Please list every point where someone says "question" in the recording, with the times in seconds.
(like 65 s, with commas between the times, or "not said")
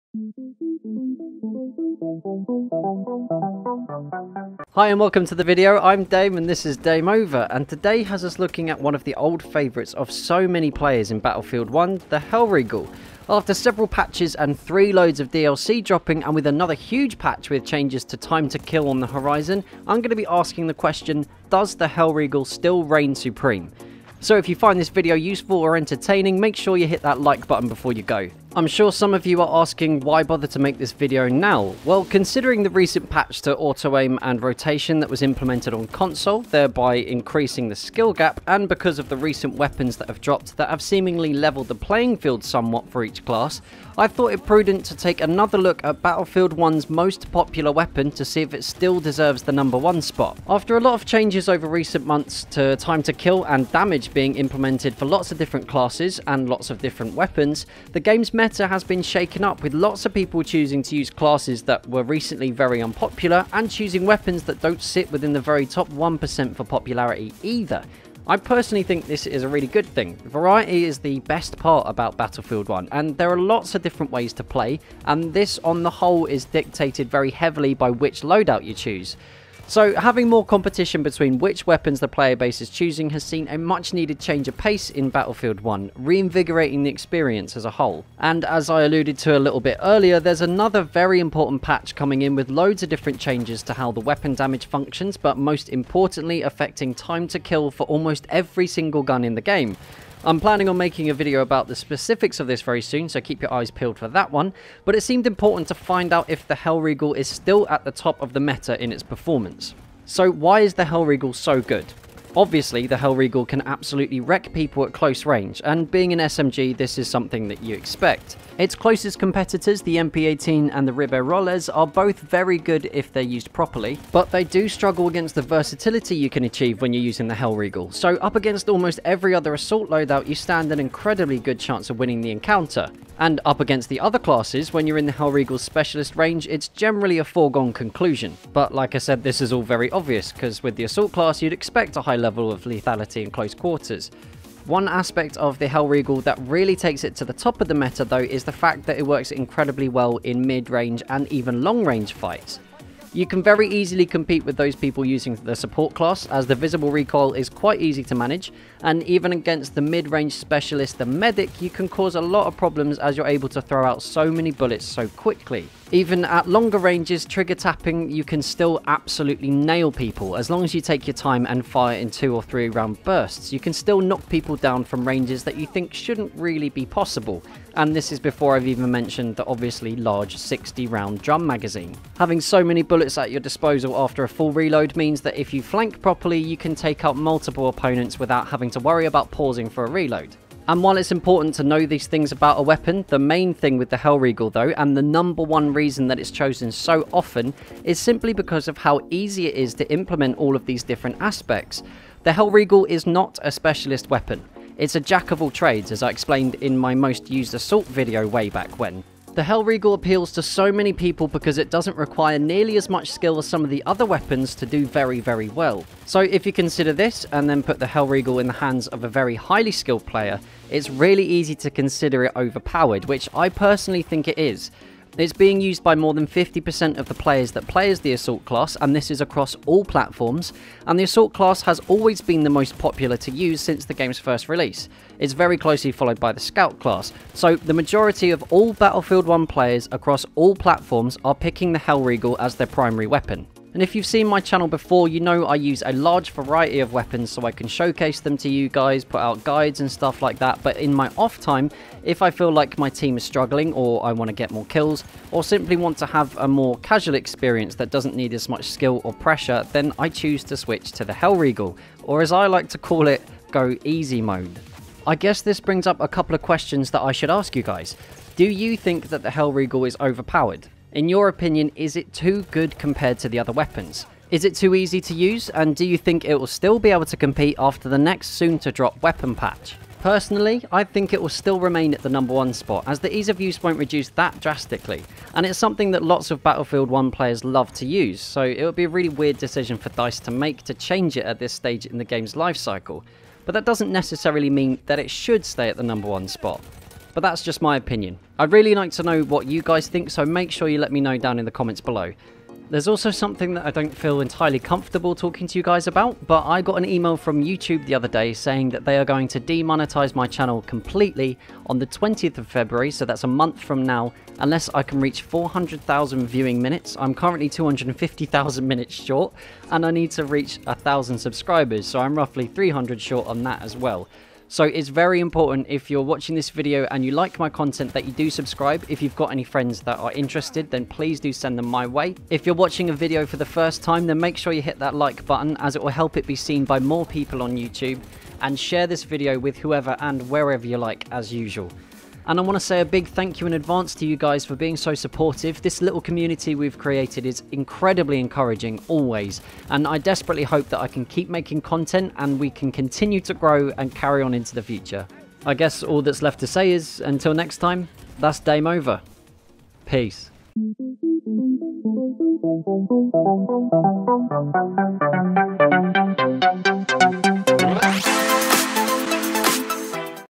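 20 s, 266 s.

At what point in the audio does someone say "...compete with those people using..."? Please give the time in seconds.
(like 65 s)
154 s.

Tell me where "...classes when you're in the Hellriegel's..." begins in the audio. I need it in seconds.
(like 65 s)
134 s.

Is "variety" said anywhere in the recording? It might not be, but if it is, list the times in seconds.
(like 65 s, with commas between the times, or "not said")
70 s, 246 s.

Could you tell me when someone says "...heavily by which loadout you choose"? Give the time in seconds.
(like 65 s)
77 s.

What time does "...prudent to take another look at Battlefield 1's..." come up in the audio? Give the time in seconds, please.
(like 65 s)
44 s.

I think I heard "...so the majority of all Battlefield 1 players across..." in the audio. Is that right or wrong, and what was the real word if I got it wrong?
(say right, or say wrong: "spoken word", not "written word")
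right.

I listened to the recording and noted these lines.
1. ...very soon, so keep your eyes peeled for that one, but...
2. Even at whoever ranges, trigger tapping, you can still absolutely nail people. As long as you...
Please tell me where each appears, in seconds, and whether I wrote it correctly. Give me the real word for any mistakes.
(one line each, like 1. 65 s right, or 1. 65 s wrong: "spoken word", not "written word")
1. 102 s right
2. 165 s wrong: "longer", not "whoever".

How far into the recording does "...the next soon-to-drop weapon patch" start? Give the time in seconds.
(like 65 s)
277 s.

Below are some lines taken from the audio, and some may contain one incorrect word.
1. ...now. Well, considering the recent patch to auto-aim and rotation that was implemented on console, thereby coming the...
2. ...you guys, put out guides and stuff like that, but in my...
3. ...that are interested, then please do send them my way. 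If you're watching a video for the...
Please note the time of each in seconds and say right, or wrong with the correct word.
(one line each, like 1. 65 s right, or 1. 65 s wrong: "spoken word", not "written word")
1. 31 s wrong: "increasing", not "coming"
2. 248 s right
3. 329 s right.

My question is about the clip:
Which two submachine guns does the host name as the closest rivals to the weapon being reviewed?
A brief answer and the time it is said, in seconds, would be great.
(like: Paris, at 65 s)
MP18 and Ribeyrolles, at 119 s.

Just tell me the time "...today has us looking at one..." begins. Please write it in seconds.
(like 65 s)
7 s.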